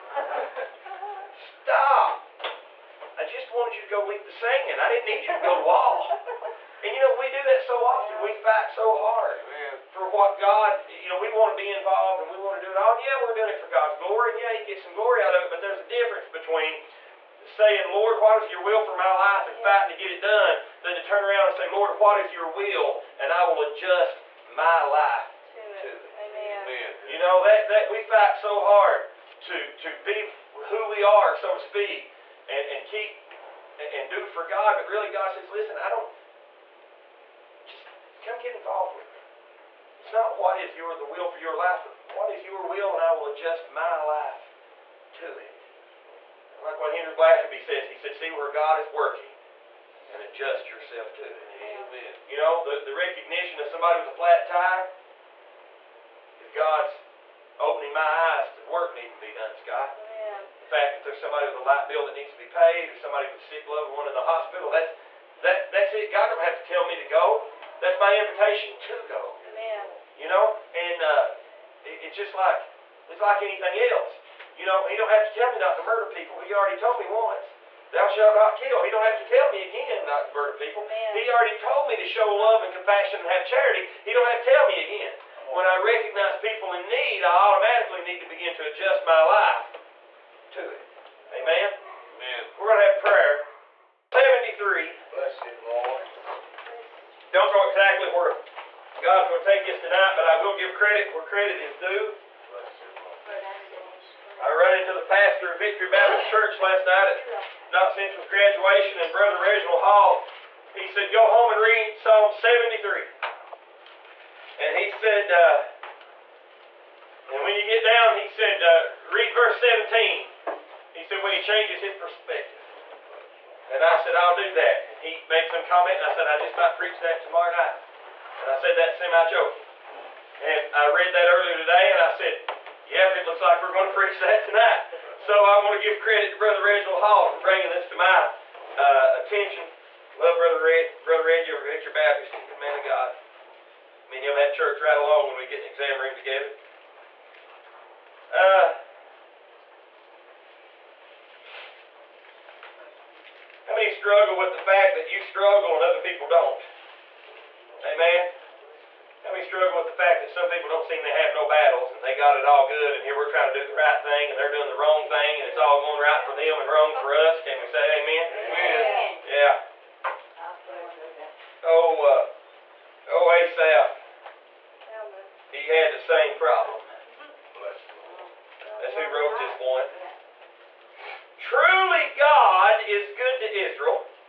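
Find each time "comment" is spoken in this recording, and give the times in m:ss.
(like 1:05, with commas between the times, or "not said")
2:05.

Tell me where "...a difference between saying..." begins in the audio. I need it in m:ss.
0:15.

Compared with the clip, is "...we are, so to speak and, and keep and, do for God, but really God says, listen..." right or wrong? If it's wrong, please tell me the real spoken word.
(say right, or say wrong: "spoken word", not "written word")
right.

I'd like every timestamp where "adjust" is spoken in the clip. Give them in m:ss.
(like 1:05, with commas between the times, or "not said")
0:23, 0:43, 0:50, 1:28.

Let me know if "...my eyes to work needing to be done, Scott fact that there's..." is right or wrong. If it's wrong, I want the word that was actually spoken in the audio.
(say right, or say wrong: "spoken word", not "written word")
right.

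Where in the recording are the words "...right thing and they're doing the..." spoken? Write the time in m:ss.
2:43.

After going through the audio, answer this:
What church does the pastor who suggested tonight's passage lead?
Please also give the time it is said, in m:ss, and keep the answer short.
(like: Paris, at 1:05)
Victory Baptist Church, at 1:45.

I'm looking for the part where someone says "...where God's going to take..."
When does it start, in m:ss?
1:38.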